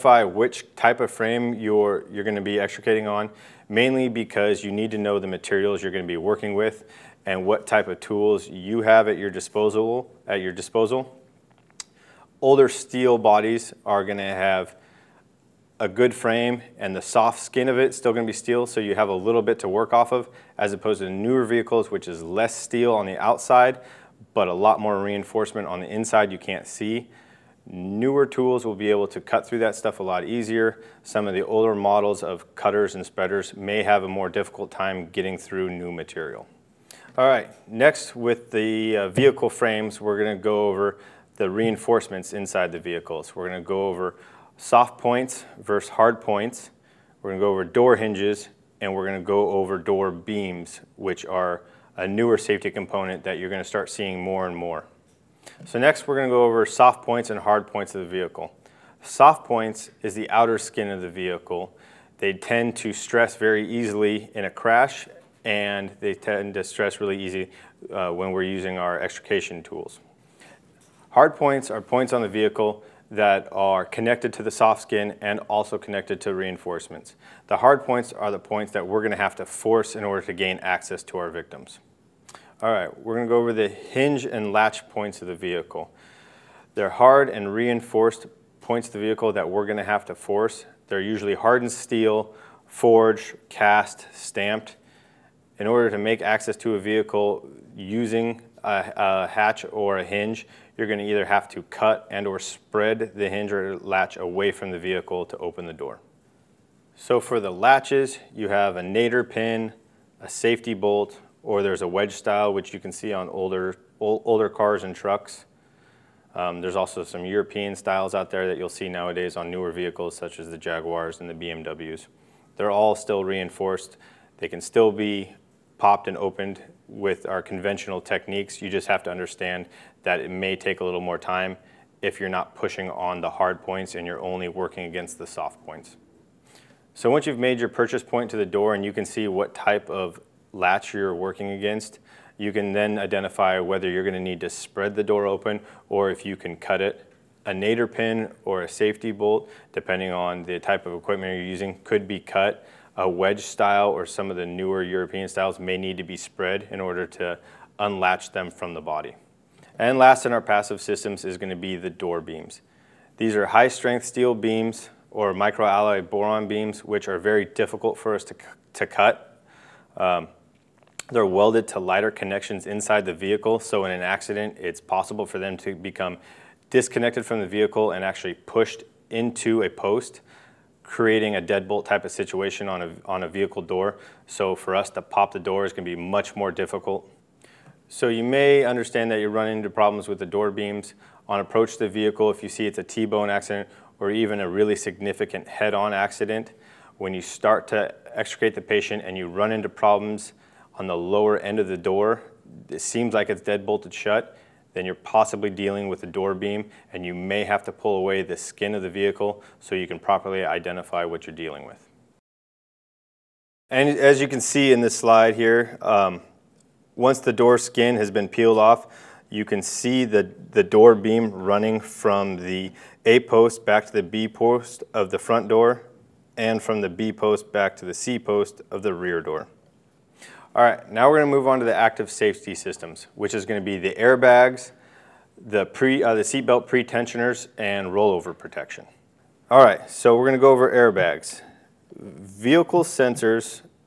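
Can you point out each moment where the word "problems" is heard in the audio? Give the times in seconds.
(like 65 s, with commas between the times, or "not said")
189 s, 199 s.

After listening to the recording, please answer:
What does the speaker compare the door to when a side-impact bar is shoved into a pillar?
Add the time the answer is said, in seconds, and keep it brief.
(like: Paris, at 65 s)
deadbolt, at 181 s.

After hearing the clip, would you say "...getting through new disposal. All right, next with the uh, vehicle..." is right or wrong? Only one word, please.
wrong.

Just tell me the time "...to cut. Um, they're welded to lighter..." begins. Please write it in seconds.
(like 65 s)
168 s.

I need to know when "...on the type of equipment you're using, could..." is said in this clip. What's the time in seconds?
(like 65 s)
150 s.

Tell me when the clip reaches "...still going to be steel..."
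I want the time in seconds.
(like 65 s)
17 s.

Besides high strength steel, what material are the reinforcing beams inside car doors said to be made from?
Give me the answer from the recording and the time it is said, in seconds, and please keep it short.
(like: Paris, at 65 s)
microalloy boron, at 165 s.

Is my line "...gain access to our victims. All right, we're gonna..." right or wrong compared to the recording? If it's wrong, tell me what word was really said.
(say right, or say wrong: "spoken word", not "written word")
right.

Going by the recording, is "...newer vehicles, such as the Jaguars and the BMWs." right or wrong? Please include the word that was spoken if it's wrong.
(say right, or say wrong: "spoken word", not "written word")
right.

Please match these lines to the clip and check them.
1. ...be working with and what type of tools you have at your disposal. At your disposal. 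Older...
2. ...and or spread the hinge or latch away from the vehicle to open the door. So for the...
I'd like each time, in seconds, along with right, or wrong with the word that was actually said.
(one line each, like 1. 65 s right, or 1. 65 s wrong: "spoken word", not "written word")
1. 6 s right
2. 102 s right.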